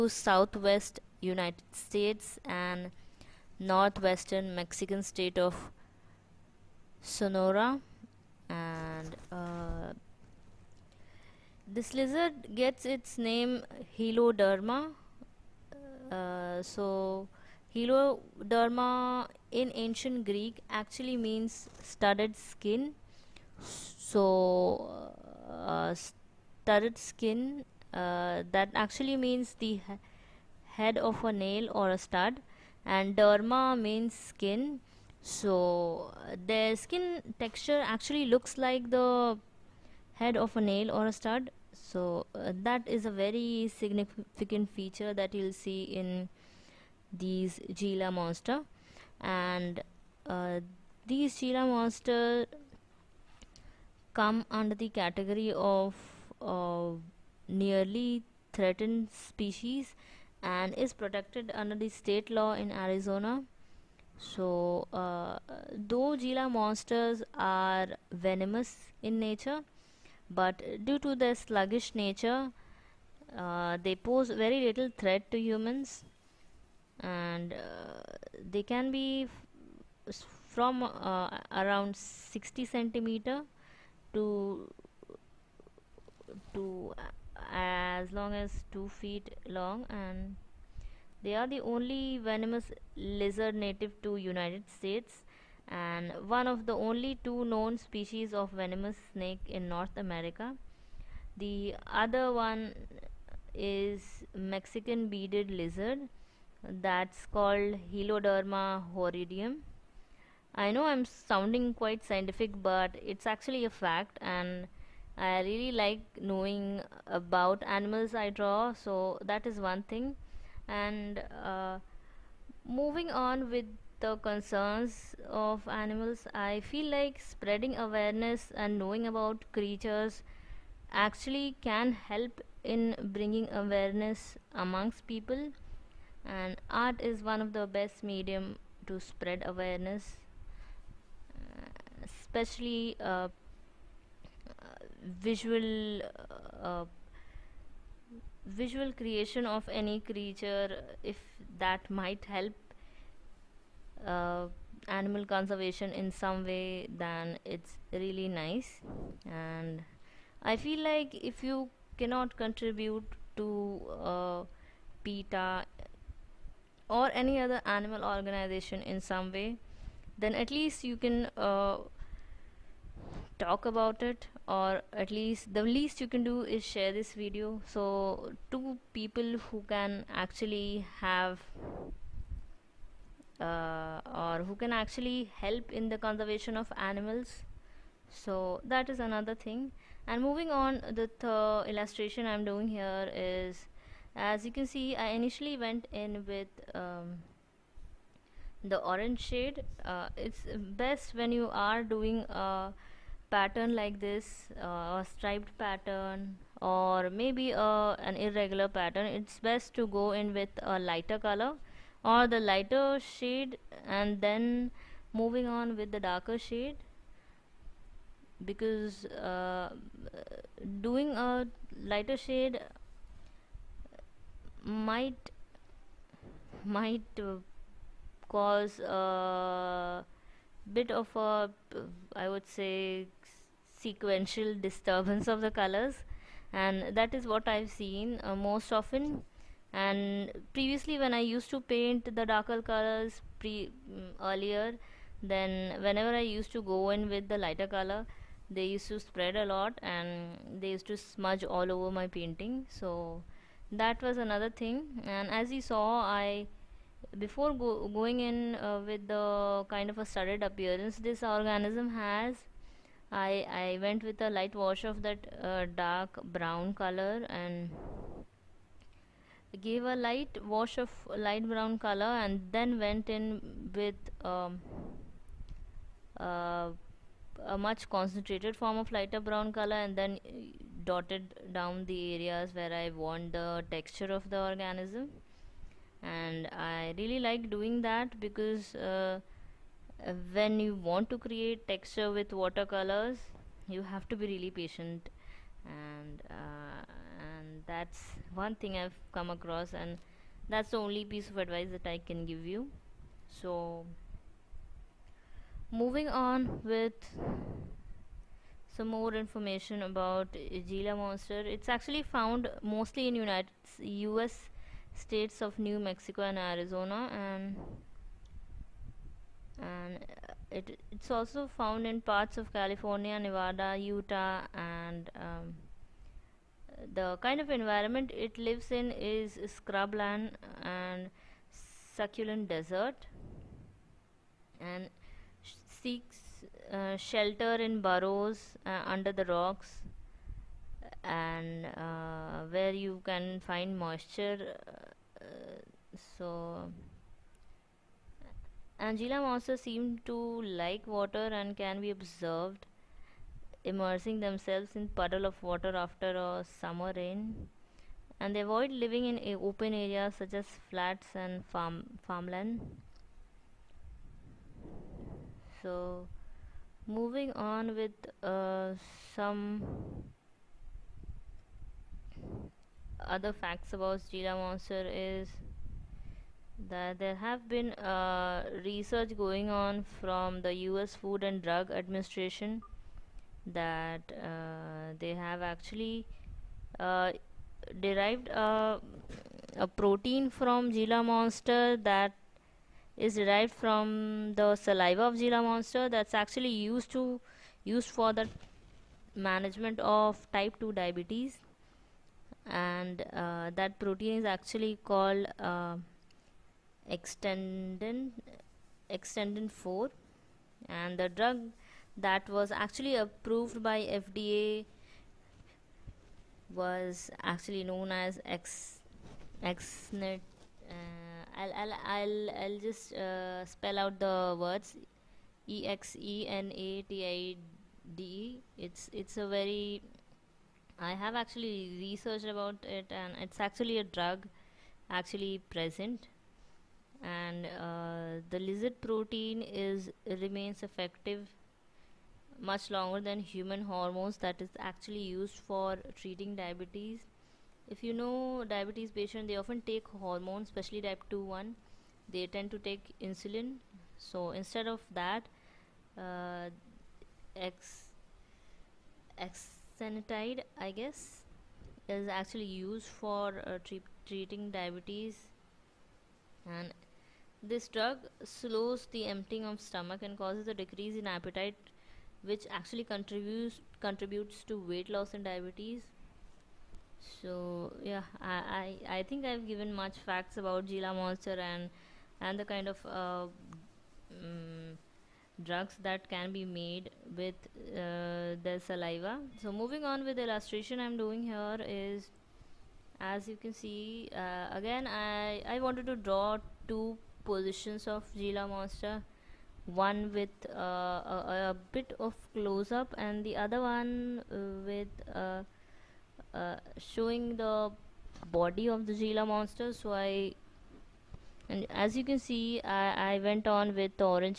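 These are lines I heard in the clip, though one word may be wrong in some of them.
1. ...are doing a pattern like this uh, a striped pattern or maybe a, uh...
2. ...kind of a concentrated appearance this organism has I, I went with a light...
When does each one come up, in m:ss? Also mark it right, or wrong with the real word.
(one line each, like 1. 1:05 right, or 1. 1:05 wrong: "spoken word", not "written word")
1. 3:21 right
2. 4:19 wrong: "studded", not "concentrated".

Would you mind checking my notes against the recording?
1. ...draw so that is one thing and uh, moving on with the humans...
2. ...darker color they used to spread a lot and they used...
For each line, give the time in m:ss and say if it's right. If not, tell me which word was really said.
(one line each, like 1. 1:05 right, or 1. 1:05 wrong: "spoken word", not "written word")
1. 1:58 wrong: "concerns", not "humans"
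2. 4:07 wrong: "lighter", not "darker".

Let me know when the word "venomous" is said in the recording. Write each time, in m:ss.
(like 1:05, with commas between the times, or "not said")
1:08, 1:32, 1:38.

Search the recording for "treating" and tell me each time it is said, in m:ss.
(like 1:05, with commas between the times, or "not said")
7:25, 7:44.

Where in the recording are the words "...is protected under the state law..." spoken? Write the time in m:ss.
1:00.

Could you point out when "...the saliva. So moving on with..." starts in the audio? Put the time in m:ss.
8:08.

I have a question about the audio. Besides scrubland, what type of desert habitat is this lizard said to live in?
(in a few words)
succulent desert.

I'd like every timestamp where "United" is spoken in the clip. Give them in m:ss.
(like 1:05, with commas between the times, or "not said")
0:01, 1:34, 5:13.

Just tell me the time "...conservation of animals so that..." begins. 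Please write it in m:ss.
3:05.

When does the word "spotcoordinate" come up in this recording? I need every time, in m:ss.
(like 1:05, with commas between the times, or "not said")
not said.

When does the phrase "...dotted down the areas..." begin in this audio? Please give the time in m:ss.
4:40.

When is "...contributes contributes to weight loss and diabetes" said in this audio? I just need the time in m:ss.
7:52.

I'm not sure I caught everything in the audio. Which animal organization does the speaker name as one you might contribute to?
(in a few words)
PETA.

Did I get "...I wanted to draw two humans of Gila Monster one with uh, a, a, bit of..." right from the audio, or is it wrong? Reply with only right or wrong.
wrong.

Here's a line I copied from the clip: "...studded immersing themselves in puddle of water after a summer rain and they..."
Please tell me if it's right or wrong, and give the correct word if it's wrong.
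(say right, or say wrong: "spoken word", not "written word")
wrong: "observed", not "studded".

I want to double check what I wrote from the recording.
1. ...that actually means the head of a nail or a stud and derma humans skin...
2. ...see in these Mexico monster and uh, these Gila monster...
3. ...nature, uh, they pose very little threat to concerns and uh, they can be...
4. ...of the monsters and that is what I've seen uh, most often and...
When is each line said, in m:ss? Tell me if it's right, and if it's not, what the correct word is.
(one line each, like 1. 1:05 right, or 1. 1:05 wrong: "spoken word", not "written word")
1. 0:28 wrong: "means", not "humans"
2. 0:45 wrong: "Gila", not "Mexico"
3. 1:11 wrong: "humans", not "concerns"
4. 3:55 wrong: "colors", not "monsters".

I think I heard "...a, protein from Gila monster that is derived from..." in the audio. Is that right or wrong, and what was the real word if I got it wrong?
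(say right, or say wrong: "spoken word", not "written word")
right.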